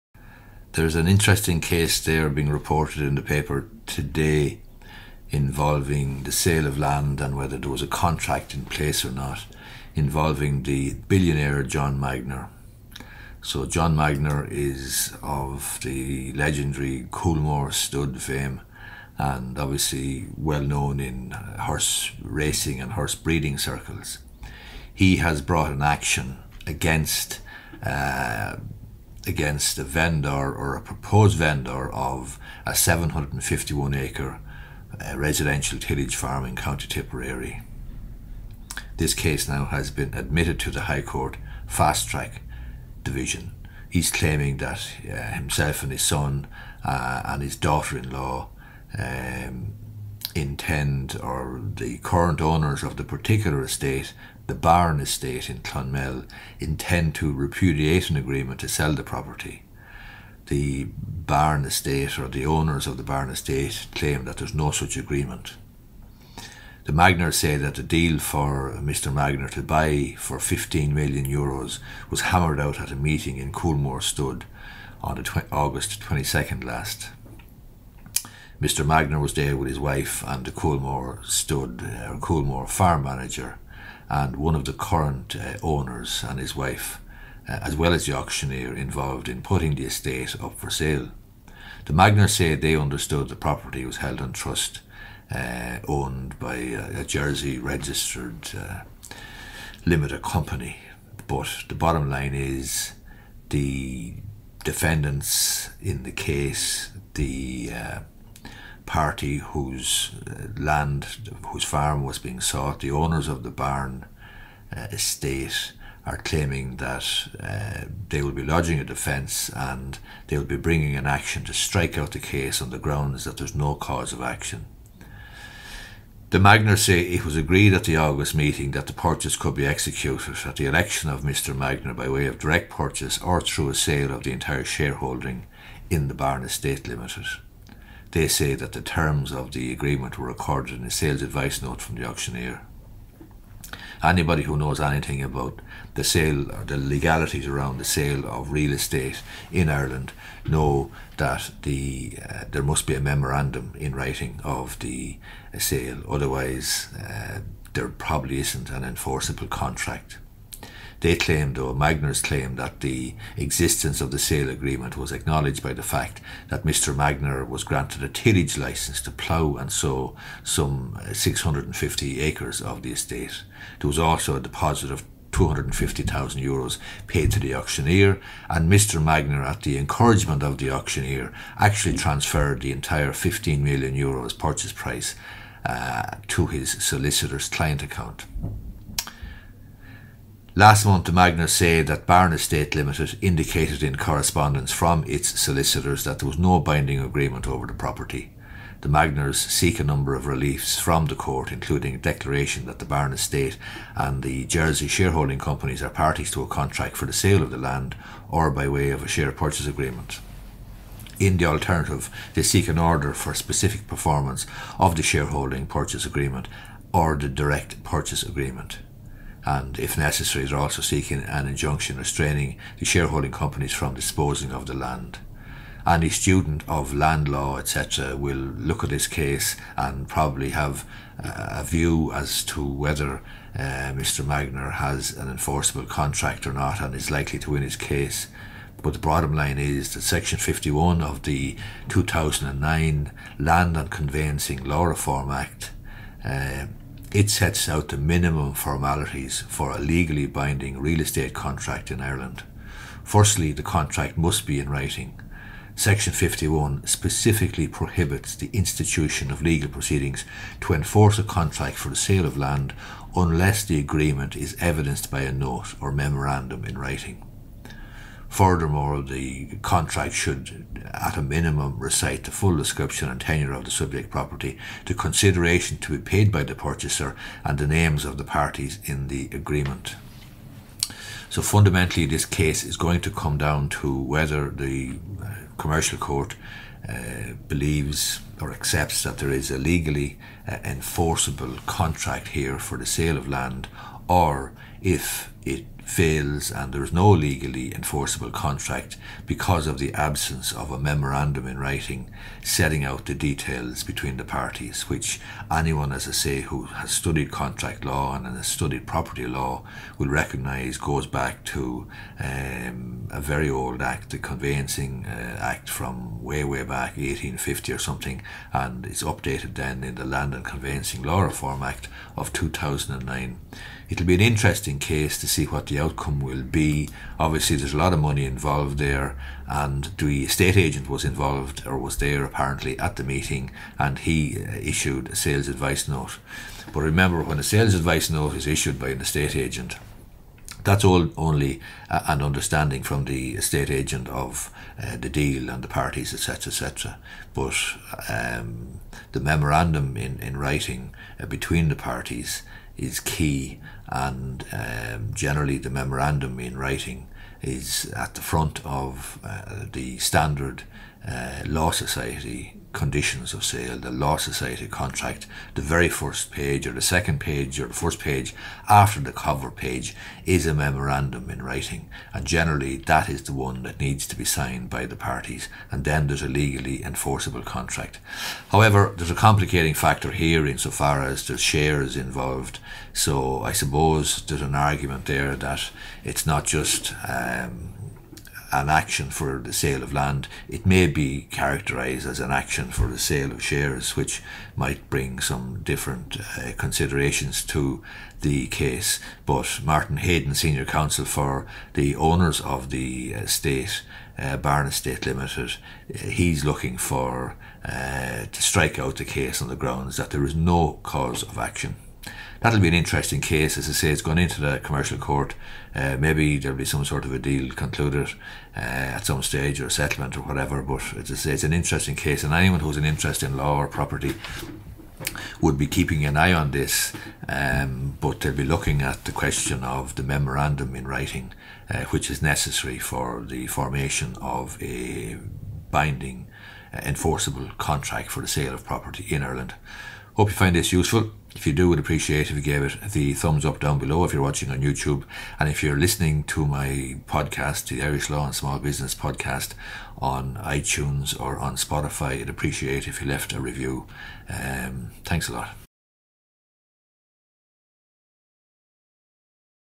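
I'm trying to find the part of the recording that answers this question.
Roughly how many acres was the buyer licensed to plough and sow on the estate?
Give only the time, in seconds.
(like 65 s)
171 s.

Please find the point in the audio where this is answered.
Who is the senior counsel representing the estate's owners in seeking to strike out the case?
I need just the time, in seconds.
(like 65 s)
399 s.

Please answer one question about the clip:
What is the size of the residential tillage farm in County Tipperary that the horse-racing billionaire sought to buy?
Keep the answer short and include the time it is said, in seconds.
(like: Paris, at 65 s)
751 acres, at 32 s.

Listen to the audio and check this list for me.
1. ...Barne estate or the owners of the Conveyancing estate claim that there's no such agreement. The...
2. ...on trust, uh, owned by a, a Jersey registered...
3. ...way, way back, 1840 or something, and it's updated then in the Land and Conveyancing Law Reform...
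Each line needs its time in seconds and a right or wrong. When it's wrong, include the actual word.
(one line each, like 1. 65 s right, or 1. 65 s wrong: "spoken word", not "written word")
1. 61 s wrong: "Barne", not "Conveyancing"
2. 94 s right
3. 316 s wrong: "1850", not "1840".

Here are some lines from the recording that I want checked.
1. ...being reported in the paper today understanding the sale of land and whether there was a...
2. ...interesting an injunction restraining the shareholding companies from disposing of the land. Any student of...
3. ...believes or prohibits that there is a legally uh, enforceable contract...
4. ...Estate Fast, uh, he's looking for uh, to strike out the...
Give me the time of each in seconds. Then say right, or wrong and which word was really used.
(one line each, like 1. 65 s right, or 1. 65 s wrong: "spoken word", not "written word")
1. 2 s wrong: "involving", not "understanding"
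2. 220 s wrong: "seeking", not "interesting"
3. 287 s wrong: "accepts", not "prohibits"
4. 404 s wrong: "Limited", not "Fast".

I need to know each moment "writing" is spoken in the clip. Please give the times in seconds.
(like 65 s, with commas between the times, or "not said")
153 s, 254 s, 266 s, 301 s, 350 s, 356 s, 371 s, 430 s.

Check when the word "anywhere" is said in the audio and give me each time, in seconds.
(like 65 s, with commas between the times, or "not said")
not said.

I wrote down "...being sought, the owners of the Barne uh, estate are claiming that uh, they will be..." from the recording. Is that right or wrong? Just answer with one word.
right.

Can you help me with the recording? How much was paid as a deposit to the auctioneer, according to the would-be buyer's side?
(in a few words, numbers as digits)
250,000 euros.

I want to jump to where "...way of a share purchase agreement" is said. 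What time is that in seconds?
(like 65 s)
208 s.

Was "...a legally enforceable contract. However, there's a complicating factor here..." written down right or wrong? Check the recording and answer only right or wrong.
right.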